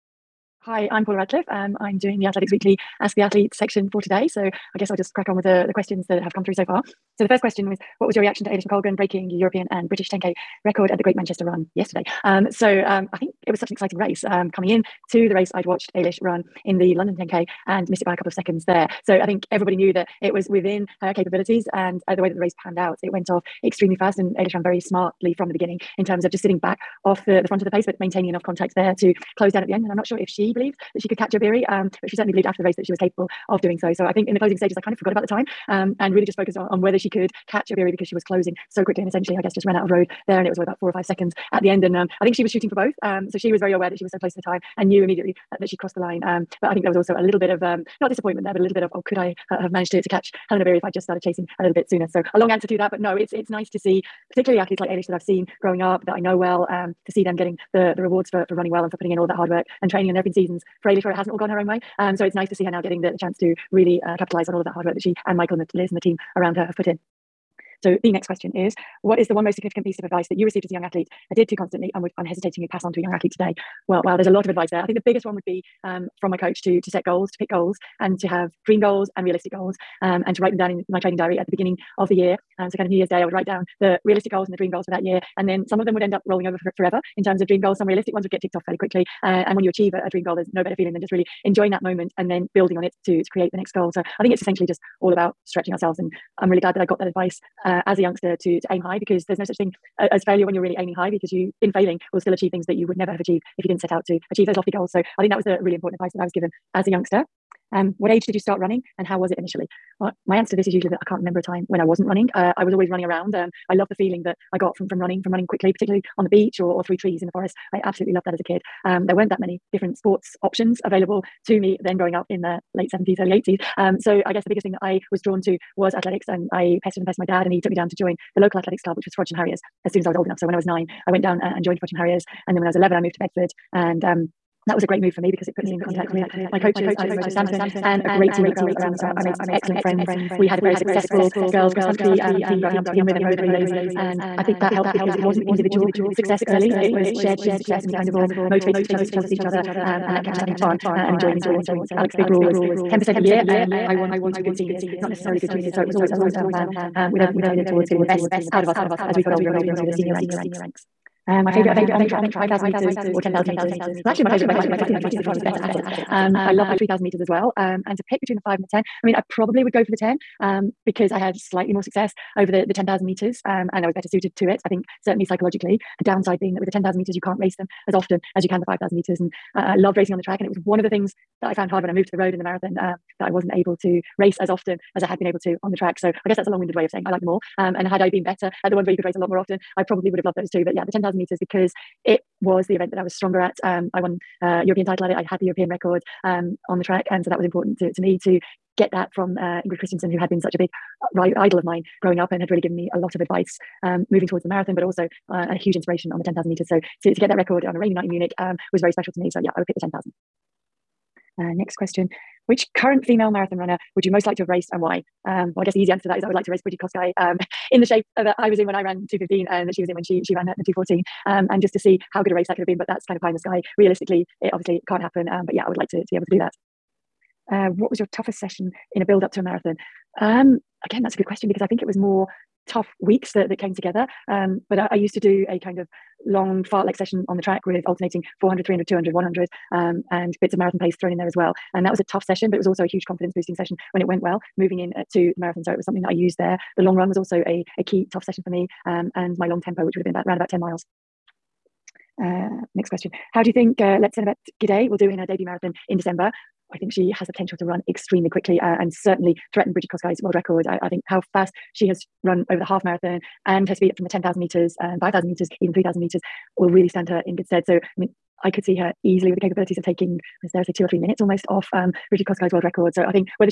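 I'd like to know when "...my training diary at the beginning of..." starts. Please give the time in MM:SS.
01:20.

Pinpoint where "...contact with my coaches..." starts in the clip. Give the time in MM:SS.
02:15.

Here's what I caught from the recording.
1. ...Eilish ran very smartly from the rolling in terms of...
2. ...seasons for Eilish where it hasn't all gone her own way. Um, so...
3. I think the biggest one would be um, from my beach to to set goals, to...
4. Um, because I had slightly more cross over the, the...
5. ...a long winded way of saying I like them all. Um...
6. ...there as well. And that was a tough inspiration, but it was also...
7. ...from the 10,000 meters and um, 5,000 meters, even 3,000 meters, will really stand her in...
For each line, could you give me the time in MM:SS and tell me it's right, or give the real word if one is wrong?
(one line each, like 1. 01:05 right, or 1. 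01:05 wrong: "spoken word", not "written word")
1. 00:24 wrong: "beginning", not "rolling"
2. 01:00 right
3. 01:14 wrong: "coach", not "beach"
4. 02:50 wrong: "success", not "cross"
5. 03:06 right
6. 04:01 wrong: "session", not "inspiration"
7. 04:23 right.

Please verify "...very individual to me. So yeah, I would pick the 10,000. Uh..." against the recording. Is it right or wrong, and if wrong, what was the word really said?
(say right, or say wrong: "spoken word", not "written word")
wrong: "special", not "individual".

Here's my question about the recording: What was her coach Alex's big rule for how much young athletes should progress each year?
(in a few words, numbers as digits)
10% a year.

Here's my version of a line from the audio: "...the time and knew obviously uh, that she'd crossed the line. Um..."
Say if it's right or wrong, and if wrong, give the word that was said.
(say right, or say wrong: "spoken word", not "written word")
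wrong: "immediately", not "obviously".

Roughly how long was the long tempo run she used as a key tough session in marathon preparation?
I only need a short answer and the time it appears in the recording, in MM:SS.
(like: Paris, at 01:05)
About 10 miles, at 04:10.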